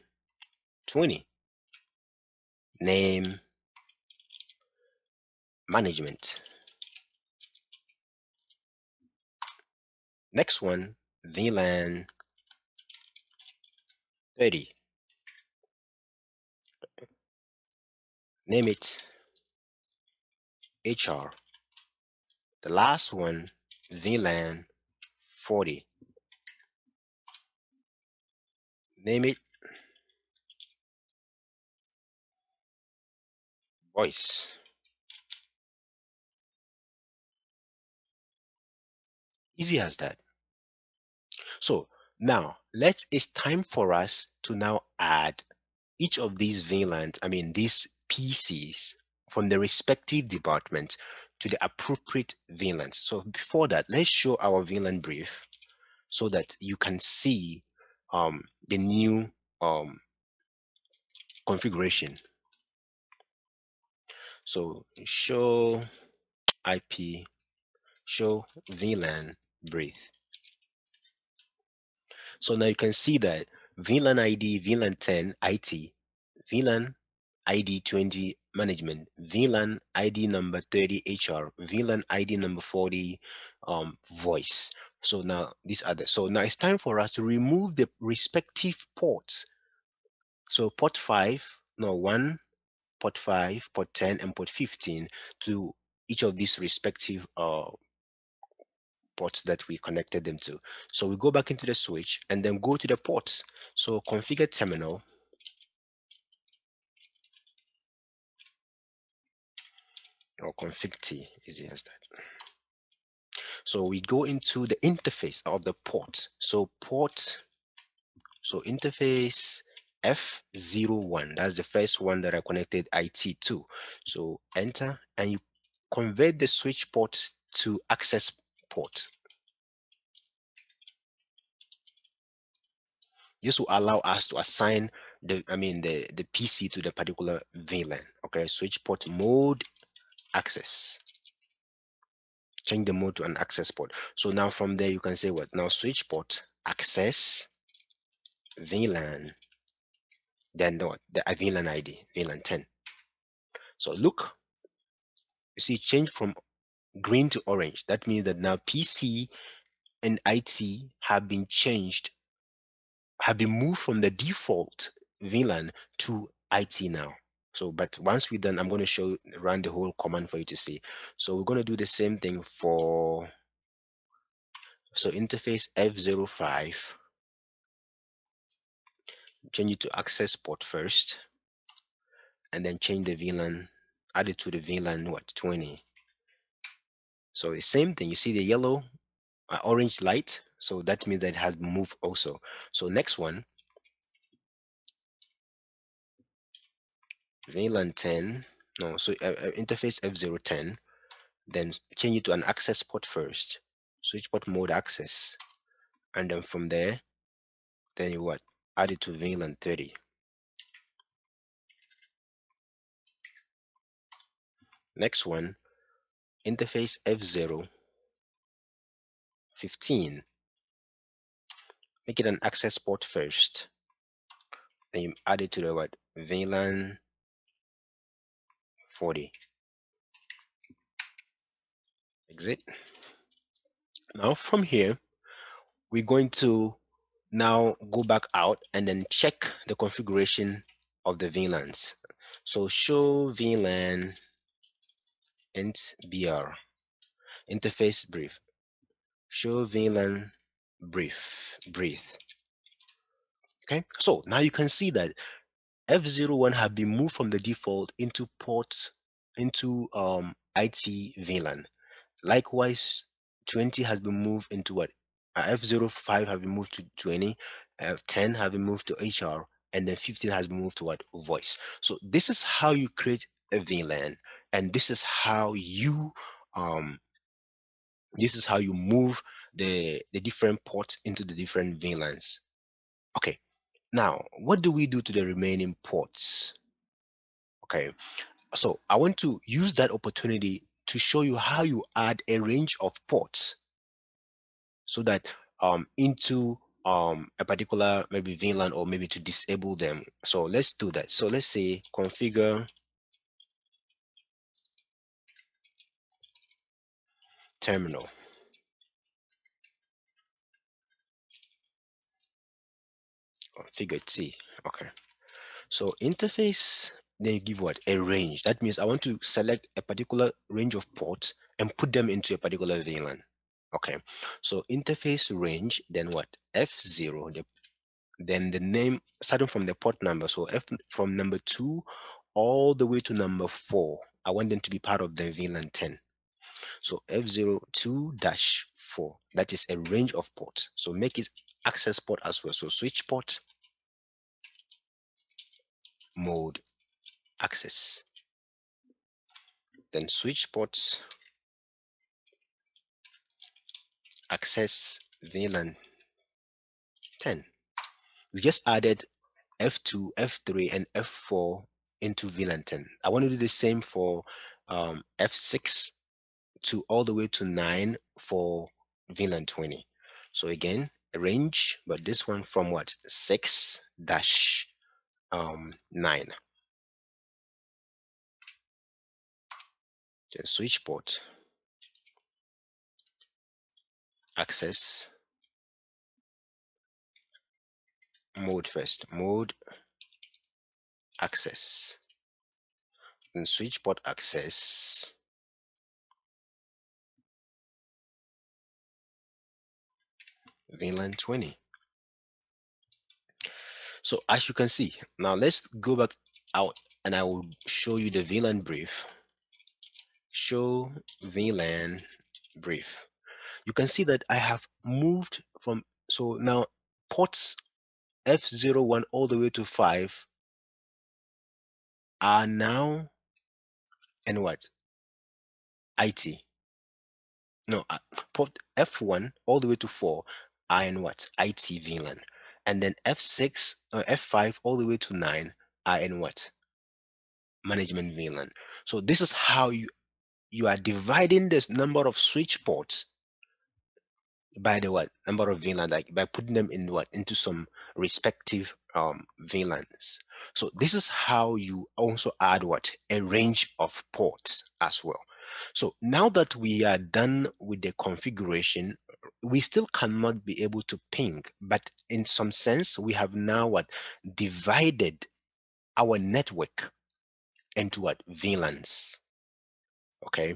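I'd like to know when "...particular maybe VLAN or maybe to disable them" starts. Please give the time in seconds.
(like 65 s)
297 s.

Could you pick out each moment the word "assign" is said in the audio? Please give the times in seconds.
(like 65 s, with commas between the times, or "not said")
134 s.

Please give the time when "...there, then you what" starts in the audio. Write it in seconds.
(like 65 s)
206 s.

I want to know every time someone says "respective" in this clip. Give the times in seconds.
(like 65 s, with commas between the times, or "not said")
49 s, 87 s, 96 s, 447 s.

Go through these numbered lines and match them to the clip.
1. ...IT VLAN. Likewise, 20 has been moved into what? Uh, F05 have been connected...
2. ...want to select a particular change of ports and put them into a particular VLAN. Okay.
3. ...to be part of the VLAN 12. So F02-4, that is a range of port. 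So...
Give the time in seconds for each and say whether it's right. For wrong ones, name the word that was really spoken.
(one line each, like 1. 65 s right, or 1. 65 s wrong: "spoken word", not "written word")
1. 260 s wrong: "moved", not "connected"
2. 318 s wrong: "range", not "change"
3. 334 s wrong: "10", not "12".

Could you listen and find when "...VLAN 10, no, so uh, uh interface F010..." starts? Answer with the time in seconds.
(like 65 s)
197 s.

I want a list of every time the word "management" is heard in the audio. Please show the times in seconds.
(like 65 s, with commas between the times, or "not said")
5 s, 78 s, 437 s.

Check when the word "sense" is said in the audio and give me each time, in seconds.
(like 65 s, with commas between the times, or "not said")
462 s.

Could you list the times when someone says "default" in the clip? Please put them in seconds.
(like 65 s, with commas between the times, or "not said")
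164 s, 257 s.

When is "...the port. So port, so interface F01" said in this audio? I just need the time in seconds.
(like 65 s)
115 s.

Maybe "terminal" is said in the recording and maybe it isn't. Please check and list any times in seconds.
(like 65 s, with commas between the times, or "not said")
104 s, 307 s.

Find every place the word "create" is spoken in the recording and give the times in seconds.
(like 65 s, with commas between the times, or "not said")
272 s.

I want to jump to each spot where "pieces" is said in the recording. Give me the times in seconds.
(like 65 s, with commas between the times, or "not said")
48 s.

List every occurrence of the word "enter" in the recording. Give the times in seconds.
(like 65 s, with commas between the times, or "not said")
124 s.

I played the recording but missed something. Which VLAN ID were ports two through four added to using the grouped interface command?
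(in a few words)
10.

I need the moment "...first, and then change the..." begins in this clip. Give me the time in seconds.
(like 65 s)
180 s.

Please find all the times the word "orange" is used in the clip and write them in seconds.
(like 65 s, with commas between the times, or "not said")
157 s, 189 s.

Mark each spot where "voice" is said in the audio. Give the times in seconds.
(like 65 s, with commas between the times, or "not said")
33 s, 84 s, 271 s.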